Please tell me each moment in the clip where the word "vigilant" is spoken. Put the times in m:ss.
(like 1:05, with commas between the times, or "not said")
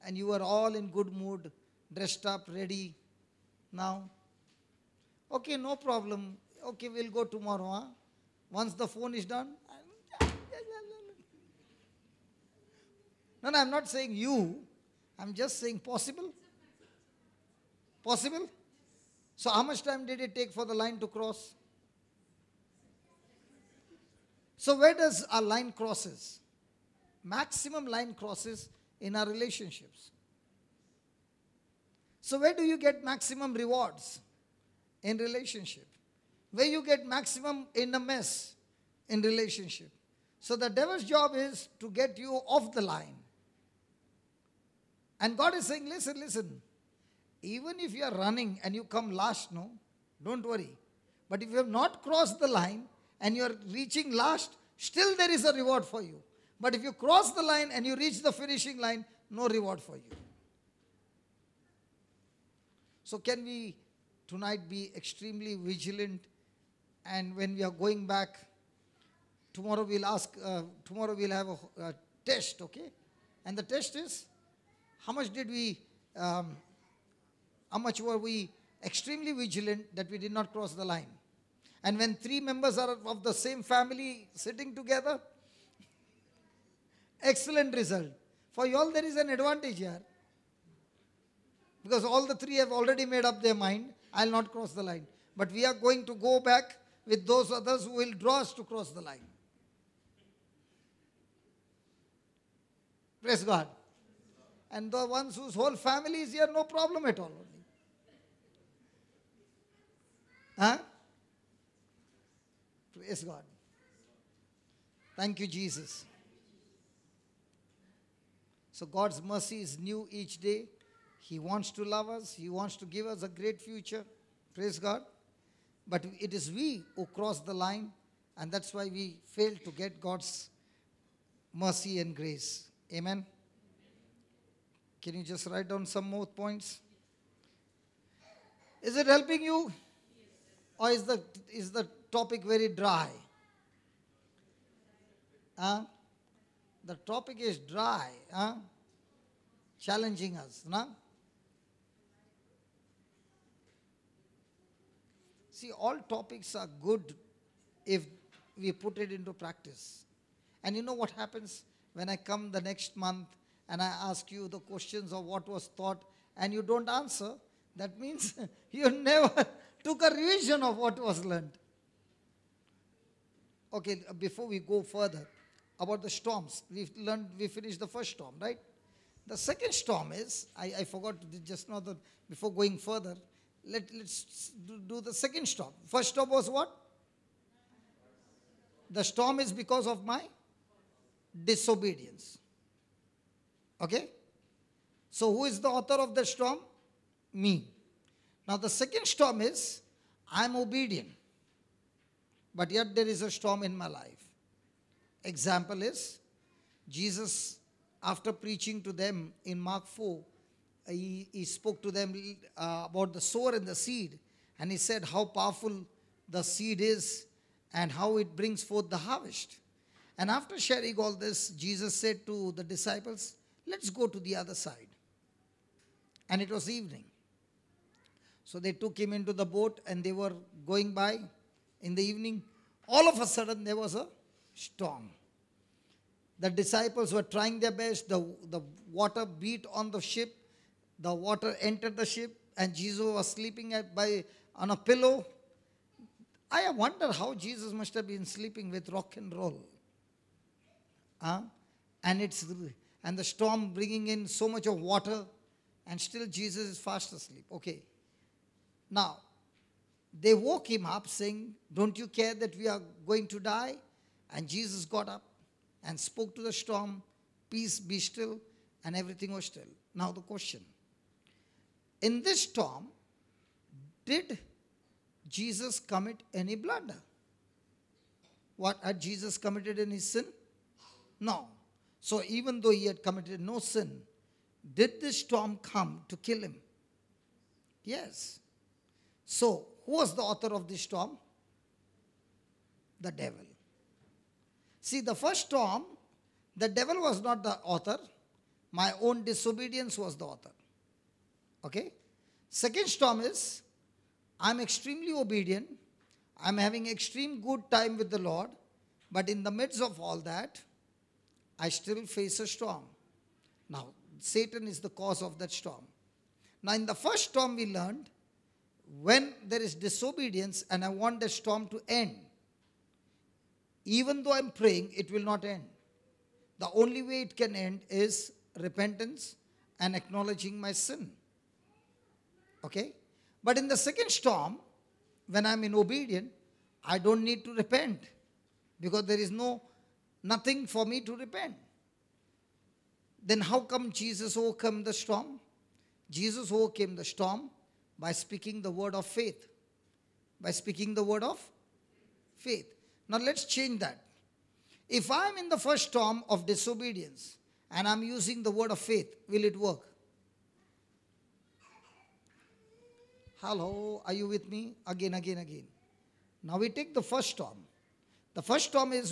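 1:05, 1:19.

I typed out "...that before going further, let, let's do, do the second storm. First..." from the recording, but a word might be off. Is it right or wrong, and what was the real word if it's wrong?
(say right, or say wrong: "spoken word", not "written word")
right.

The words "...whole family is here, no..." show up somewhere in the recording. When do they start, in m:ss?
1:45.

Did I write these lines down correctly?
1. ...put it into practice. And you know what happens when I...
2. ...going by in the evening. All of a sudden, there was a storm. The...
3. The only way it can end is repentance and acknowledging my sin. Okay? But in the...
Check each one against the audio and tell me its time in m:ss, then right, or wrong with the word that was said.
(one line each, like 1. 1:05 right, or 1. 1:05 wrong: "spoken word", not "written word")
1. 2:38 right
2. 3:50 right
3. 5:26 right.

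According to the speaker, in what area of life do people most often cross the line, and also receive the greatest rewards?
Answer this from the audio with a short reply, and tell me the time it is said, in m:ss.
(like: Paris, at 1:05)
Relationships, at 0:27.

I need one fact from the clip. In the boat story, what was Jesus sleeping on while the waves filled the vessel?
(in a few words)
A pillow.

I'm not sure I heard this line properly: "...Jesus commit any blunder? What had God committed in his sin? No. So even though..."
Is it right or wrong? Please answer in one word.
wrong.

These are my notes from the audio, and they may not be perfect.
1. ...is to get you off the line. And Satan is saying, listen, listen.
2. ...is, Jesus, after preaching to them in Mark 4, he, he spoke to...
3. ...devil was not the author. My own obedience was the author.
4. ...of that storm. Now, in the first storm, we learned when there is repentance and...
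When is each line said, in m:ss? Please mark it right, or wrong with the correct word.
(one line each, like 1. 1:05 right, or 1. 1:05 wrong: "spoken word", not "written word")
1. 0:41 wrong: "God", not "Satan"
2. 3:25 right
3. 4:56 wrong: "disobedience", not "obedience"
4. 5:15 wrong: "disobedience", not "repentance".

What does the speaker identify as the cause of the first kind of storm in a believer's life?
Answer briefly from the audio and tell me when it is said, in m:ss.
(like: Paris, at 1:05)
My disobedience, at 3:10.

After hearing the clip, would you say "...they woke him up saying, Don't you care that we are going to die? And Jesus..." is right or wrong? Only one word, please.
right.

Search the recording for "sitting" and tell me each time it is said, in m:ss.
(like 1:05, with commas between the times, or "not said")
1:24.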